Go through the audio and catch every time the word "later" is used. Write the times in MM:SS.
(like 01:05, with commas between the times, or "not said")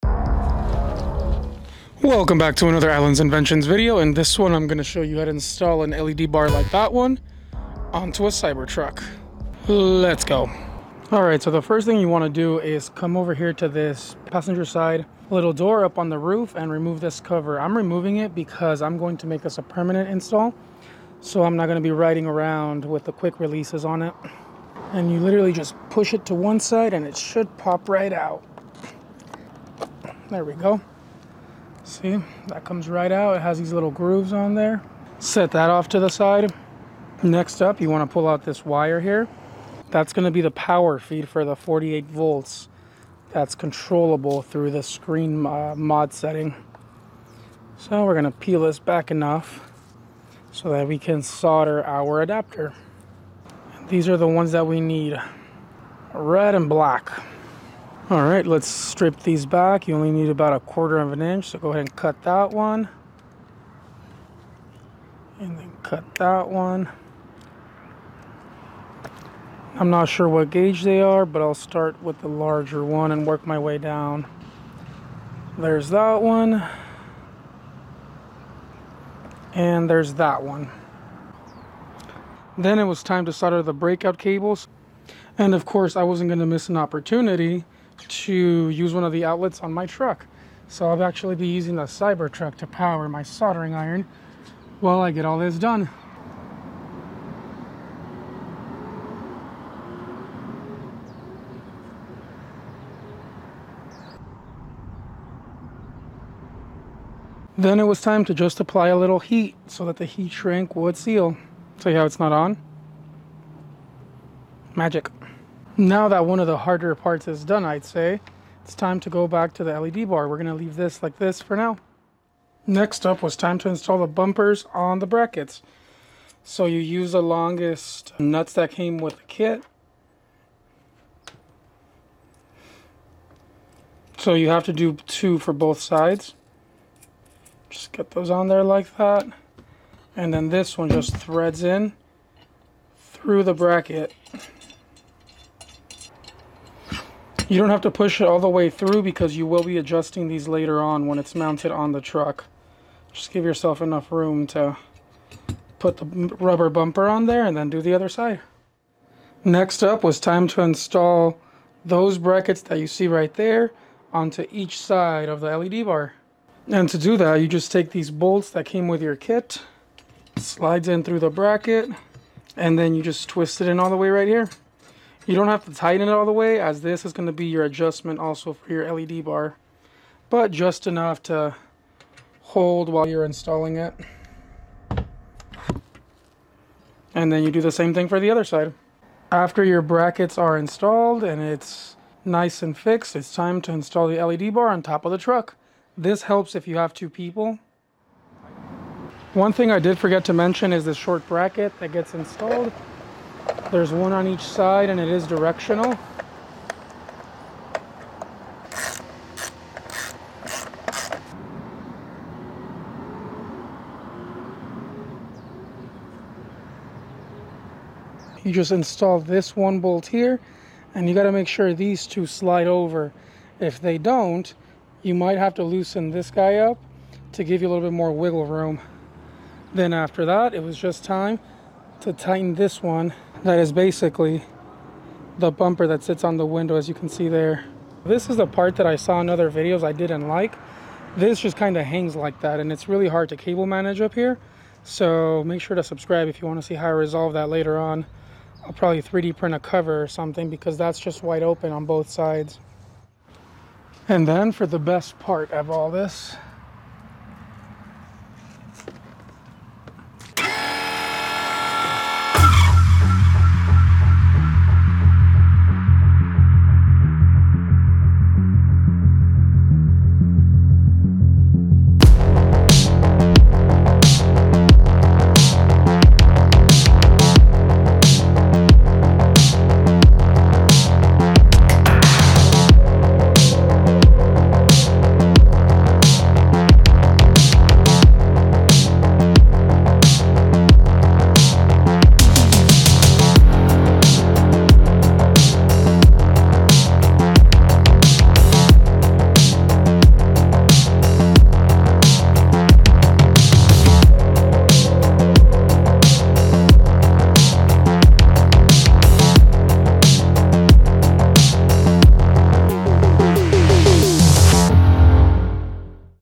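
02:30, 04:07.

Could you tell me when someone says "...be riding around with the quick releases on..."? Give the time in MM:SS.
00:21.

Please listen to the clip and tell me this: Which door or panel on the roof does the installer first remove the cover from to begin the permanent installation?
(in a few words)
passenger side.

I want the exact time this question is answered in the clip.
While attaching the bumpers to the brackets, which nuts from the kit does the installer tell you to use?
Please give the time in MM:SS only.
02:07.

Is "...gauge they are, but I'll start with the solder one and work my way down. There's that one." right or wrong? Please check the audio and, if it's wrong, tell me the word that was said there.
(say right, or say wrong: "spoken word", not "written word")
wrong: "larger", not "solder".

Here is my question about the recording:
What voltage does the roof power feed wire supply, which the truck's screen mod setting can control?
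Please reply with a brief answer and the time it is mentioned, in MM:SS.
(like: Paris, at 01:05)
48 volts, at 00:41.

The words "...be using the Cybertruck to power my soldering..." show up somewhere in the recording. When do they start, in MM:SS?
01:31.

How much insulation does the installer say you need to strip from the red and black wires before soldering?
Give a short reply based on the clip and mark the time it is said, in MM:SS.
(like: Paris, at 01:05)
a quarter of an inch, at 01:00.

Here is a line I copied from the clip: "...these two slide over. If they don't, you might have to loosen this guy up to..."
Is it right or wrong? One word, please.
right.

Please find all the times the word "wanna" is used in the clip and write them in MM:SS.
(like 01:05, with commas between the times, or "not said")
00:12.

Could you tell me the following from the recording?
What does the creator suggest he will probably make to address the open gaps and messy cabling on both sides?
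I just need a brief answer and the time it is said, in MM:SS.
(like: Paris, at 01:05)
3D print a cover, at 04:09.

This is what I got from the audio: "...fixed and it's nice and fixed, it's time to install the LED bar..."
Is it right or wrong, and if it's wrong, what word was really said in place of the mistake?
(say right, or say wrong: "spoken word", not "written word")
wrong: "installed", not "fixed".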